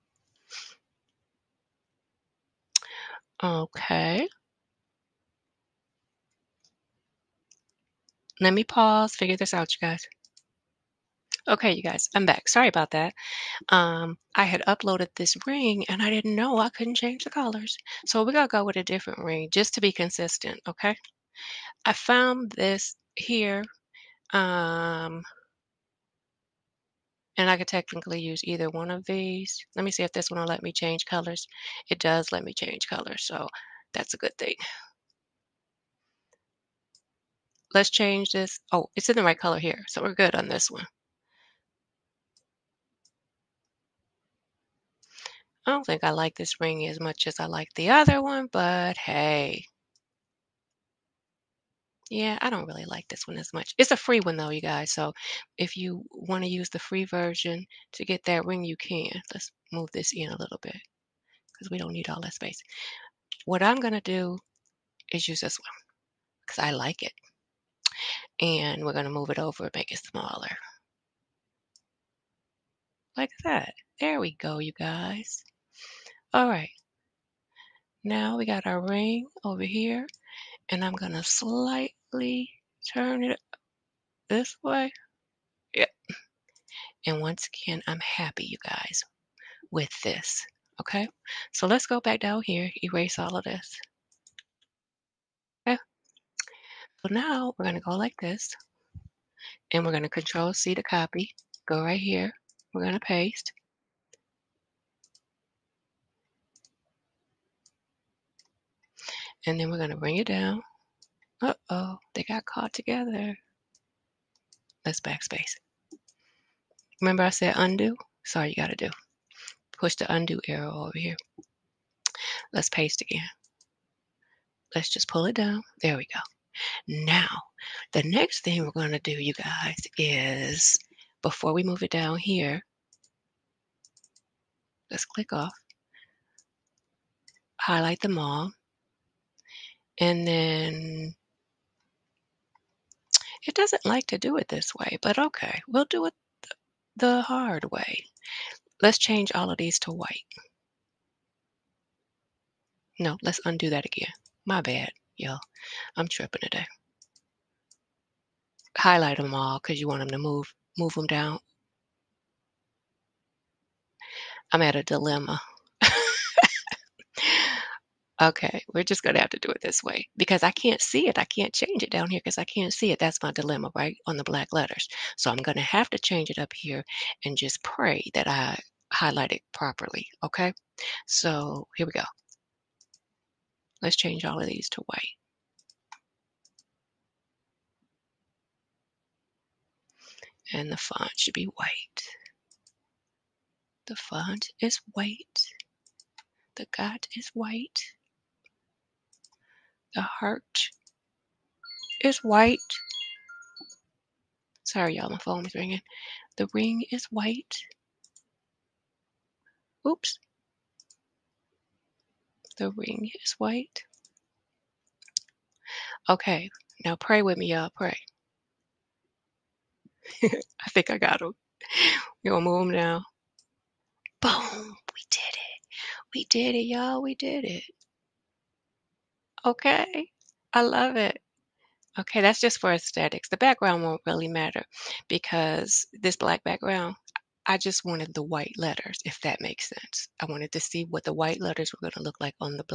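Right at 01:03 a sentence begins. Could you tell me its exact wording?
What I'm going to do is use this one because I like it.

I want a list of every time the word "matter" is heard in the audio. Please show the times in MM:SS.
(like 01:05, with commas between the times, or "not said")
03:54.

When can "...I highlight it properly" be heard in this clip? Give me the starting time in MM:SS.
02:58.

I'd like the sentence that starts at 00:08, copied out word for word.
Let me pause, figure this out, you guys.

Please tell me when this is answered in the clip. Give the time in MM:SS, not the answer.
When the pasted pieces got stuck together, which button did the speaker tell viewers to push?
02:00.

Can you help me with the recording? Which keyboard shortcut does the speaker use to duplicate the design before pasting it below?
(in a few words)
Control C.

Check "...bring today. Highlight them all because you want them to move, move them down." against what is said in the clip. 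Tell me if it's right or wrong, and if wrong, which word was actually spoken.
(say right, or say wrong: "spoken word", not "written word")
wrong: "tripping", not "bring".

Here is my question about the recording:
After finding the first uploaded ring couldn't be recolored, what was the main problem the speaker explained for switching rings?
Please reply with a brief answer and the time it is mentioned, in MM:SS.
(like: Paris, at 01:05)
couldn't change the colors, at 00:16.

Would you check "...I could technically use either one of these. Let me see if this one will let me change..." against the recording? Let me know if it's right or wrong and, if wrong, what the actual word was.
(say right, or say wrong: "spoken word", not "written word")
right.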